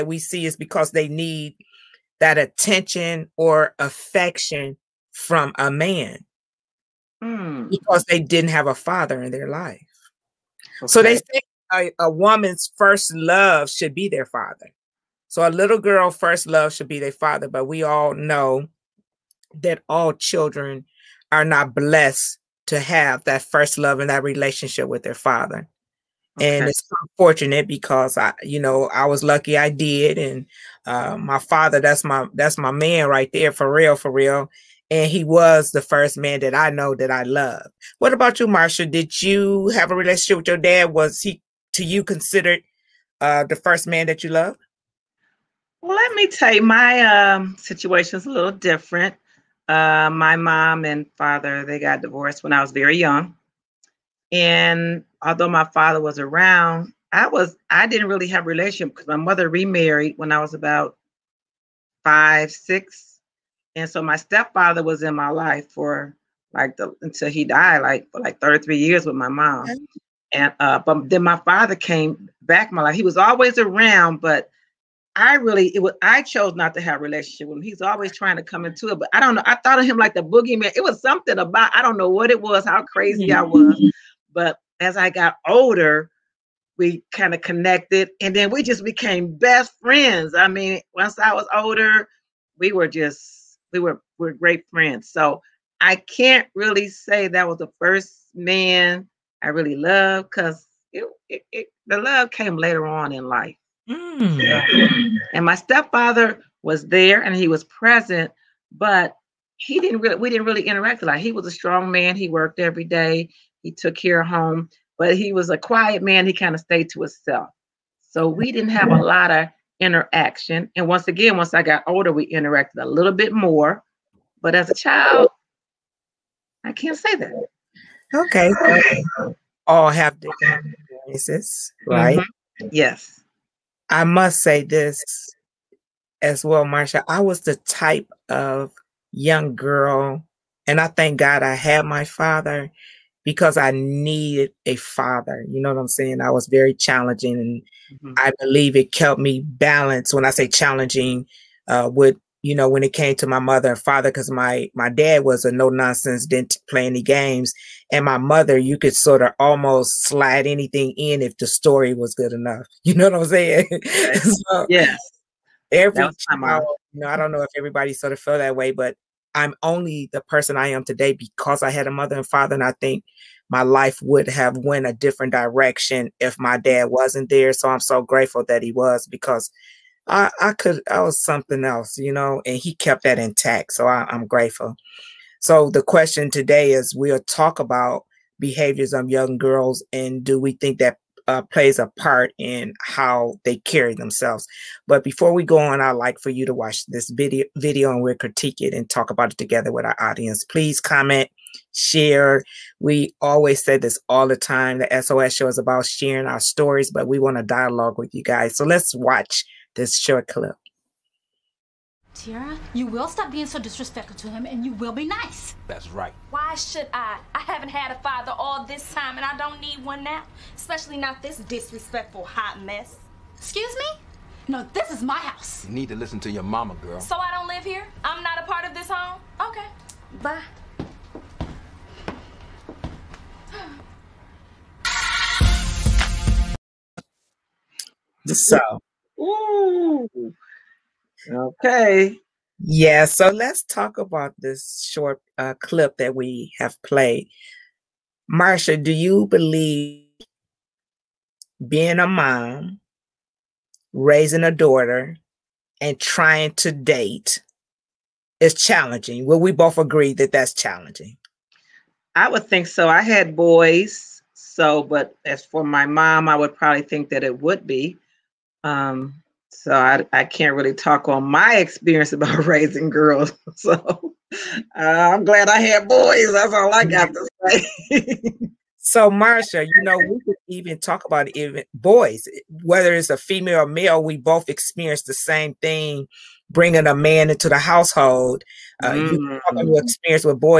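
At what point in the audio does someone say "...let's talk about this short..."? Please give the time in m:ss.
4:03.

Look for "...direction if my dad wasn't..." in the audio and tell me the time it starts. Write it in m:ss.
2:55.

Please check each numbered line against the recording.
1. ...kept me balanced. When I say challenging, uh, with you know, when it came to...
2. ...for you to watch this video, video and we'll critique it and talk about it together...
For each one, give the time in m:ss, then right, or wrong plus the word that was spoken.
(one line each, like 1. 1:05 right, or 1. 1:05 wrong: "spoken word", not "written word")
1. 2:28 right
2. 3:16 right.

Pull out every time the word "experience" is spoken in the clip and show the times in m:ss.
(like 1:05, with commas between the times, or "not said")
2:10, 4:31, 4:44, 4:49.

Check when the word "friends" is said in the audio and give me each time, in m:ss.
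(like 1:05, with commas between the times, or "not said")
1:29, 1:34.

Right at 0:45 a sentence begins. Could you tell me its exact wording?
Well, let me tell you, my um, situation is a little different.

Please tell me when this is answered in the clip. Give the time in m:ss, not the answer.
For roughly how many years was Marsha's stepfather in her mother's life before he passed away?
1:08.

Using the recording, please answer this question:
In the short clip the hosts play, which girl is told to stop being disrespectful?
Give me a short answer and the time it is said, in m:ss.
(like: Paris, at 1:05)
Tiara, at 3:32.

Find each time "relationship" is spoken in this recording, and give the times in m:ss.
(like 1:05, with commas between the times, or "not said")
0:24, 0:39, 0:58, 1:17.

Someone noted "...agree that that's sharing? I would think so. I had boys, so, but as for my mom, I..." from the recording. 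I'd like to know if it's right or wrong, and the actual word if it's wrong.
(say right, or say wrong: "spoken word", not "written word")
wrong: "challenging", not "sharing".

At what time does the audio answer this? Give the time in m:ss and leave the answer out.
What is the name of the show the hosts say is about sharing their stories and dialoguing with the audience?
3:24.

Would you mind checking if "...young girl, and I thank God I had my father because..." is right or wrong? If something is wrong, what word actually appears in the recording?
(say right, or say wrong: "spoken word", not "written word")
right.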